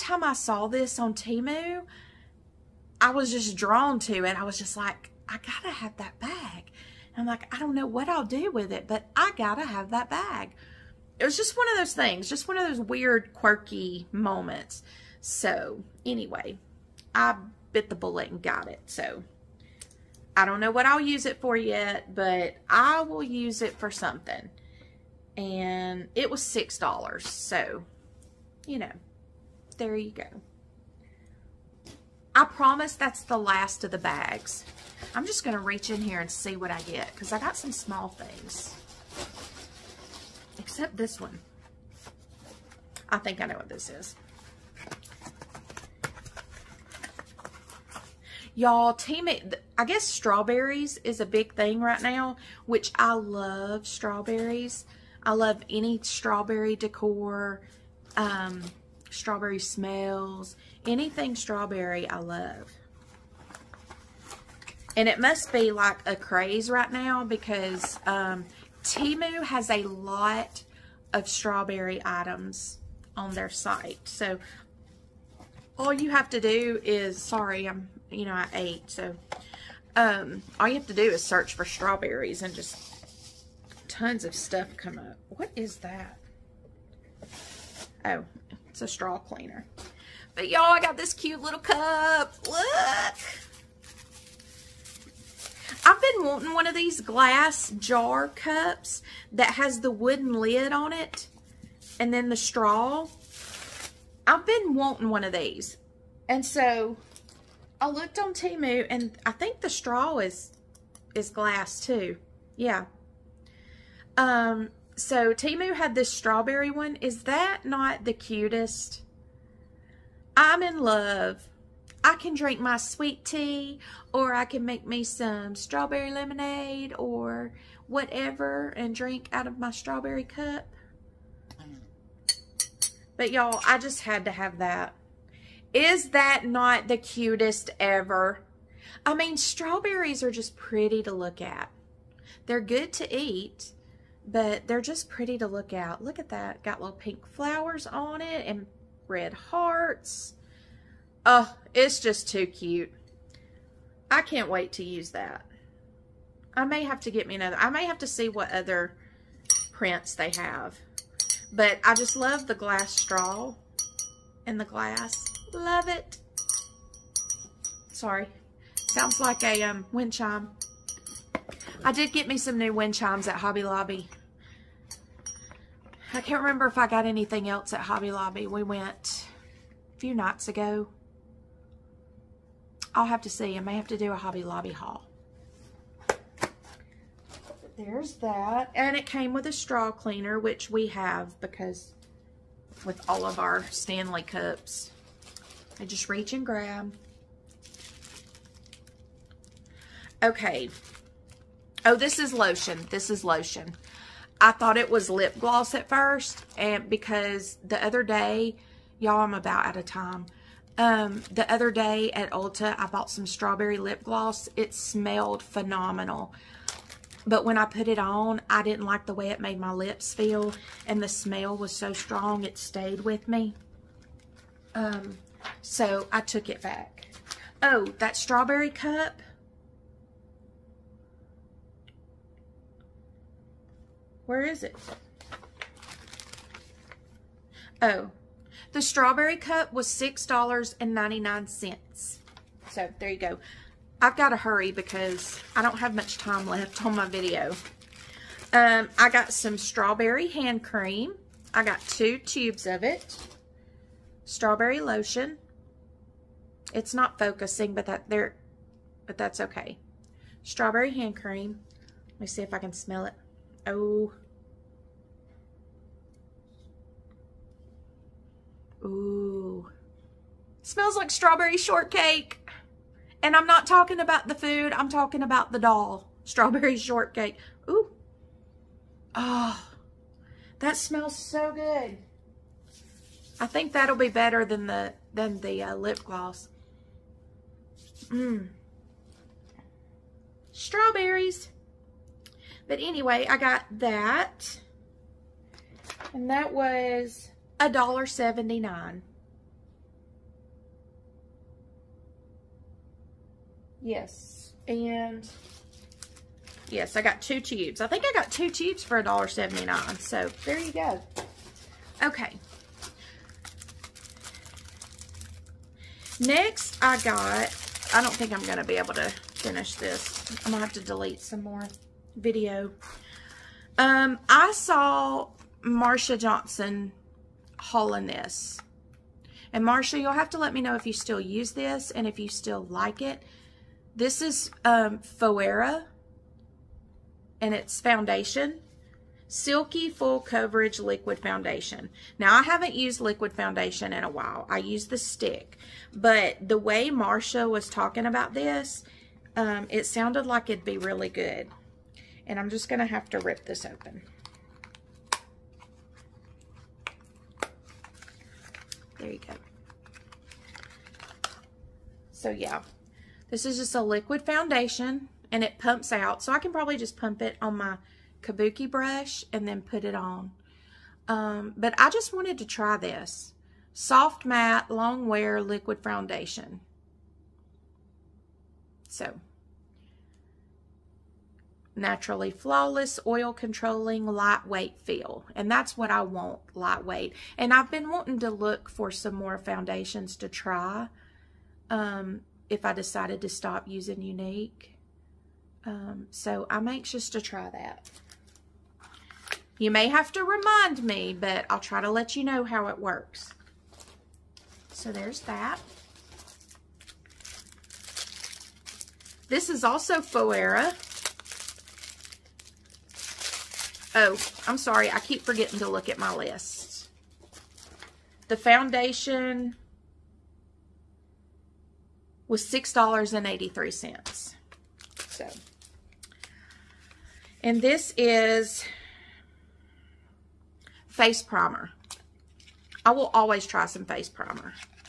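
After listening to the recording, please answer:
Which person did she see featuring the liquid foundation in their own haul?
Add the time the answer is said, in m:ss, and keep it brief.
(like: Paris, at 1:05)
Marsha Johnson, at 5:25.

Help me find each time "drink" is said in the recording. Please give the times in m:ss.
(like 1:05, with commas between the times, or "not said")
2:02, 2:08.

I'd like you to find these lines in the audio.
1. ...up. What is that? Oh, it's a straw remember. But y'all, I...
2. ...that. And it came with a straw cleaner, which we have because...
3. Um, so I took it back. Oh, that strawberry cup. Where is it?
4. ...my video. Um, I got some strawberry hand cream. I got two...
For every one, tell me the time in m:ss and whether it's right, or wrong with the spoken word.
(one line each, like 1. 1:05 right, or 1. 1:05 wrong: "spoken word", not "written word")
1. 1:24 wrong: "cleaner", not "remember"
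2. 3:08 right
3. 3:44 right
4. 4:06 right.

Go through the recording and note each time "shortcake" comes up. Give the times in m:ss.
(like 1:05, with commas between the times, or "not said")
4:31, 4:36.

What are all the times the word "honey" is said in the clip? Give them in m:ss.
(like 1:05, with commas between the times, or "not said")
not said.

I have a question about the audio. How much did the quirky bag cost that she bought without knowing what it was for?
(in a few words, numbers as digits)
$6.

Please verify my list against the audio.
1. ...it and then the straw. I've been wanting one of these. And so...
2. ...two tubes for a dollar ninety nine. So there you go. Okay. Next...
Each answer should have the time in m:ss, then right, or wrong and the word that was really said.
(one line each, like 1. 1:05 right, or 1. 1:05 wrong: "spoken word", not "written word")
1. 1:40 right
2. 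5:08 wrong: "seventy", not "ninety".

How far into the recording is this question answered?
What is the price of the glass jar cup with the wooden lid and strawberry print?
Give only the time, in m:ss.
3:59.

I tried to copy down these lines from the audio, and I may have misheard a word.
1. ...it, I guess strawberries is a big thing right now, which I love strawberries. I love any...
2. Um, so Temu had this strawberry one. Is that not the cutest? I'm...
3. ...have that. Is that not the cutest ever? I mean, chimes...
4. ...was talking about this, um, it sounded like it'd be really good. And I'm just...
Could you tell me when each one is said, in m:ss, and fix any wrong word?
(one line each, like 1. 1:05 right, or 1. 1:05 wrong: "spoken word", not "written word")
1. 0:49 right
2. 1:54 right
3. 2:14 wrong: "strawberries", not "chimes"
4. 5:47 right.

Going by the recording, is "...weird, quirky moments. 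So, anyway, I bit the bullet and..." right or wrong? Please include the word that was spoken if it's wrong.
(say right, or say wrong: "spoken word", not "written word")
right.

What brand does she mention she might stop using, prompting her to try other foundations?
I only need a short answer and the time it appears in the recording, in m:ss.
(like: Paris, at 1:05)
Younique, at 6:33.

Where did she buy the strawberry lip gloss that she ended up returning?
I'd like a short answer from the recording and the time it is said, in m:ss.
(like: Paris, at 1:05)
Ulta, at 3:32.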